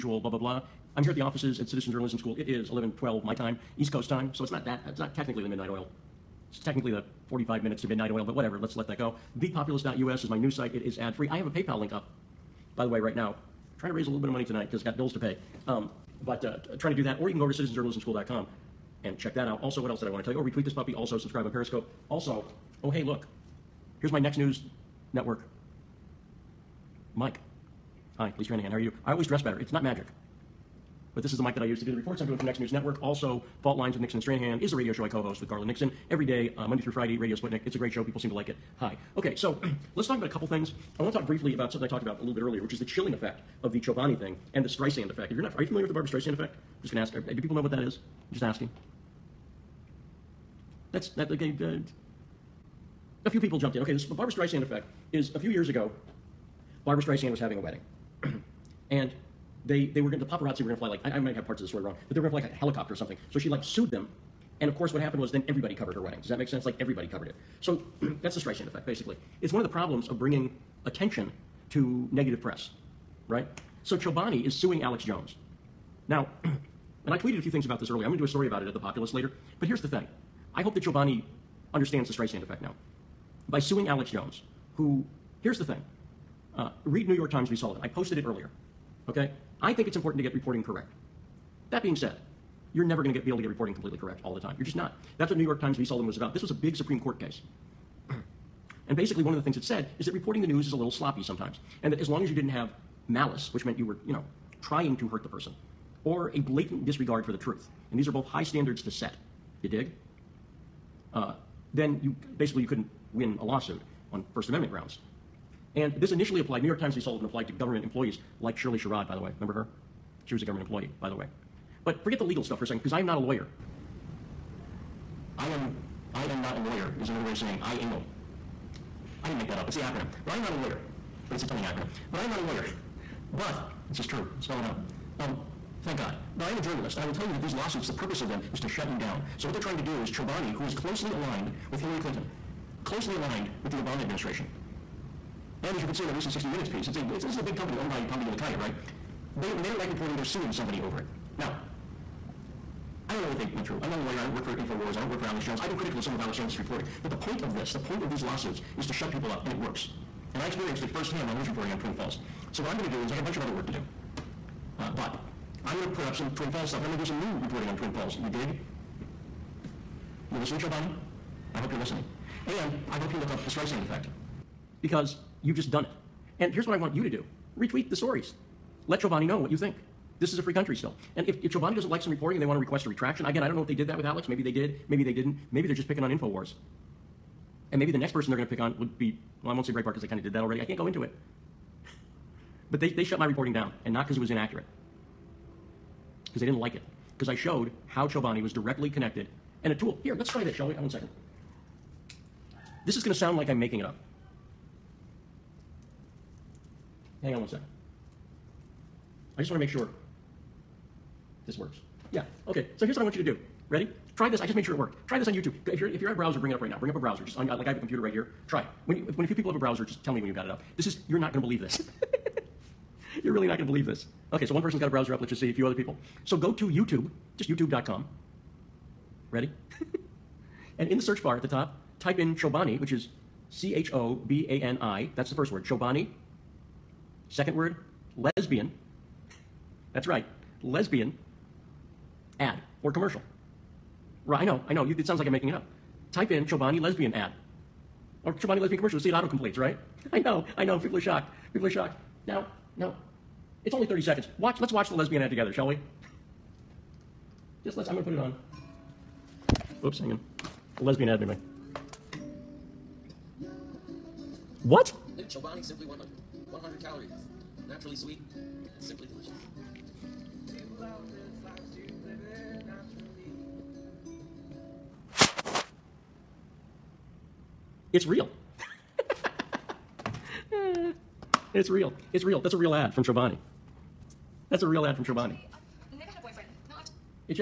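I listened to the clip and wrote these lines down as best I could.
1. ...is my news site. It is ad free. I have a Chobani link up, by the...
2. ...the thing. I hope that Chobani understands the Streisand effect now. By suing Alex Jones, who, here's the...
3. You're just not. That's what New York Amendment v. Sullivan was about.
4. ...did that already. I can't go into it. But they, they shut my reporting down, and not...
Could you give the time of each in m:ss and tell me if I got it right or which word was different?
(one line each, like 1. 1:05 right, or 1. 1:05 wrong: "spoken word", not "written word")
1. 0:10 wrong: "PayPal", not "Chobani"
2. 1:19 right
3. 1:34 wrong: "Times", not "Amendment"
4. 3:10 right.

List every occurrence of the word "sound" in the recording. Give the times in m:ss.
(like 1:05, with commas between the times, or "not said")
3:23, 4:05.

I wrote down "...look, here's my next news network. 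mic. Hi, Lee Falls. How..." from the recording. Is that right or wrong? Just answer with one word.
wrong.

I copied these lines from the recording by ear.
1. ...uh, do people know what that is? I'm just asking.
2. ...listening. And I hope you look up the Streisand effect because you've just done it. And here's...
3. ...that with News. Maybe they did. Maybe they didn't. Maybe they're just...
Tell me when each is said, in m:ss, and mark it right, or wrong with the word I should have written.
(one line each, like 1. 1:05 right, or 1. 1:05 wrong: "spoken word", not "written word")
1. 0:47 right
2. 2:51 right
3. 3:03 wrong: "Alex", not "News".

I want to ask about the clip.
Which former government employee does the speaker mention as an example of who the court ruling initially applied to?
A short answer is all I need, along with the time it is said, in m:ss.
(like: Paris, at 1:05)
Shirley Sherrod, at 1:58.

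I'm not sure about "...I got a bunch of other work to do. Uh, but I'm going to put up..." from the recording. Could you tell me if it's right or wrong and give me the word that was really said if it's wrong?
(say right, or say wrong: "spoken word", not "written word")
right.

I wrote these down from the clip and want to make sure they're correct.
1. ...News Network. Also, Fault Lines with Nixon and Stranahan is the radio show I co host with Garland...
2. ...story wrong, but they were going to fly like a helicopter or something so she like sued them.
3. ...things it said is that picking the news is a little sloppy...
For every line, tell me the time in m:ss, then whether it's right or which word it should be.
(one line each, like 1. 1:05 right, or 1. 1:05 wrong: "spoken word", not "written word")
1. 0:32 right
2. 1:01 right
3. 1:39 wrong: "reporting", not "picking".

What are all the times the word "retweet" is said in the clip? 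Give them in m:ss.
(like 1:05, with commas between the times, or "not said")
0:20, 2:57.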